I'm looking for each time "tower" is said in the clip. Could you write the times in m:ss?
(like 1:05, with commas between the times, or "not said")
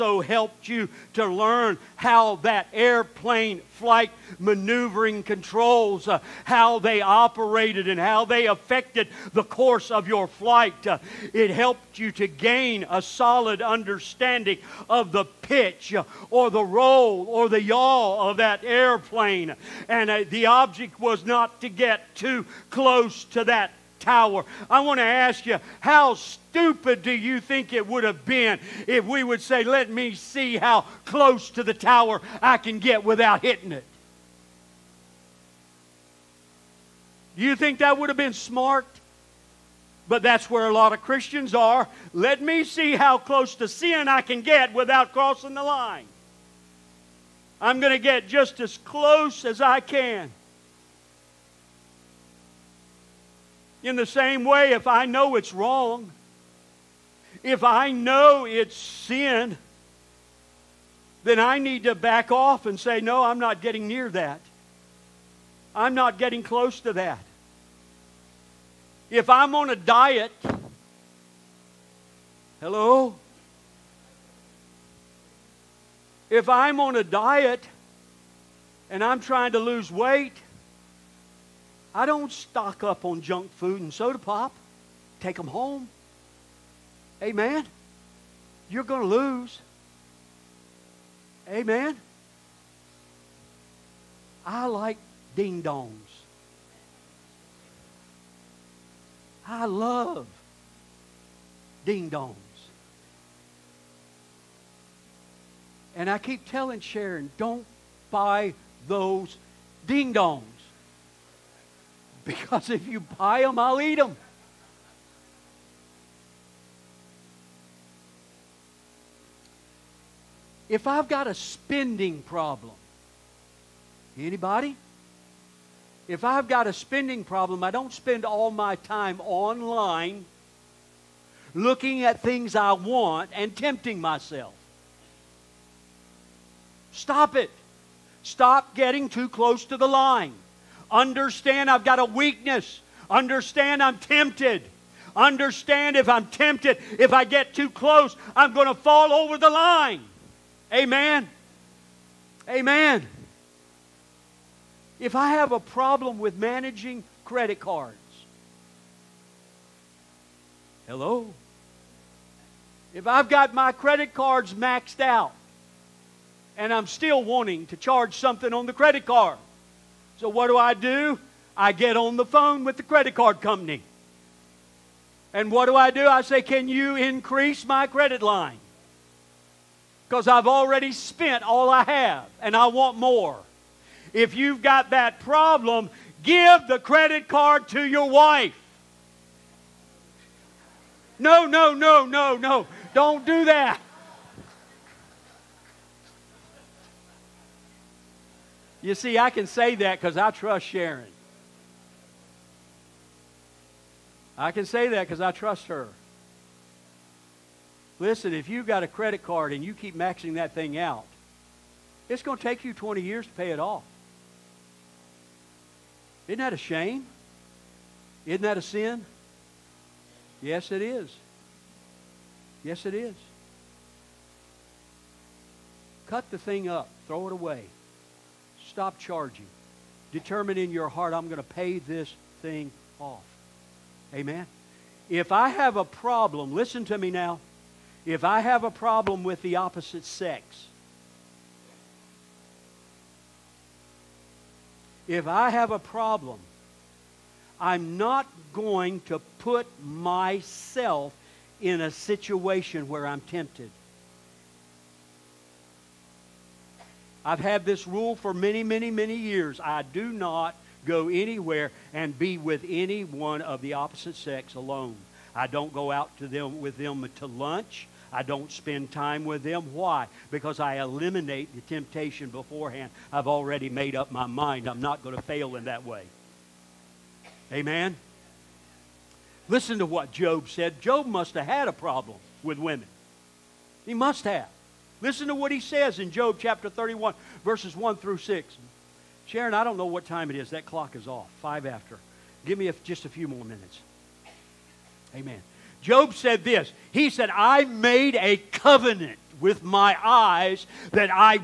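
0:23, 0:31.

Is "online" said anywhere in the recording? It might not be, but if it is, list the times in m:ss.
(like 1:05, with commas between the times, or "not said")
2:09.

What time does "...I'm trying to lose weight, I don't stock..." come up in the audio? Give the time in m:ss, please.
1:19.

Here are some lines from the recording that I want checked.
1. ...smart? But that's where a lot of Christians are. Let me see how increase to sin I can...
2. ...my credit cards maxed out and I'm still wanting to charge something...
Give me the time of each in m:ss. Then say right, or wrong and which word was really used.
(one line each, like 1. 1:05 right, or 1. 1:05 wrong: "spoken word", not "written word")
1. 0:38 wrong: "close", not "increase"
2. 2:43 right.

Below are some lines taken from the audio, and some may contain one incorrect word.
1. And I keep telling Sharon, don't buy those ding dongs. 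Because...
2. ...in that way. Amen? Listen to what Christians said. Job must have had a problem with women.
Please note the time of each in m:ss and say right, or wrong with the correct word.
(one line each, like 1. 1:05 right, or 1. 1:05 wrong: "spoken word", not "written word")
1. 1:45 right
2. 4:35 wrong: "Job", not "Christians".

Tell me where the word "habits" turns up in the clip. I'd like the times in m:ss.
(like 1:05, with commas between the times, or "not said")
not said.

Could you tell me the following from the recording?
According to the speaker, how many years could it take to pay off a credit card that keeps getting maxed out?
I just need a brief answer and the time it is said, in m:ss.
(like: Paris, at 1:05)
20, at 3:32.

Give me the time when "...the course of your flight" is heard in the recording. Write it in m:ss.
0:09.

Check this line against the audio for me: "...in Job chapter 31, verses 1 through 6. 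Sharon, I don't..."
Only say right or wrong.
right.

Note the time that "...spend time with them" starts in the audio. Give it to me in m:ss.
4:28.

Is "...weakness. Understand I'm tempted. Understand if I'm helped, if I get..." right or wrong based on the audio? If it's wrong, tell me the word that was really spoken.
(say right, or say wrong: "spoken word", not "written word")
wrong: "tempted", not "helped".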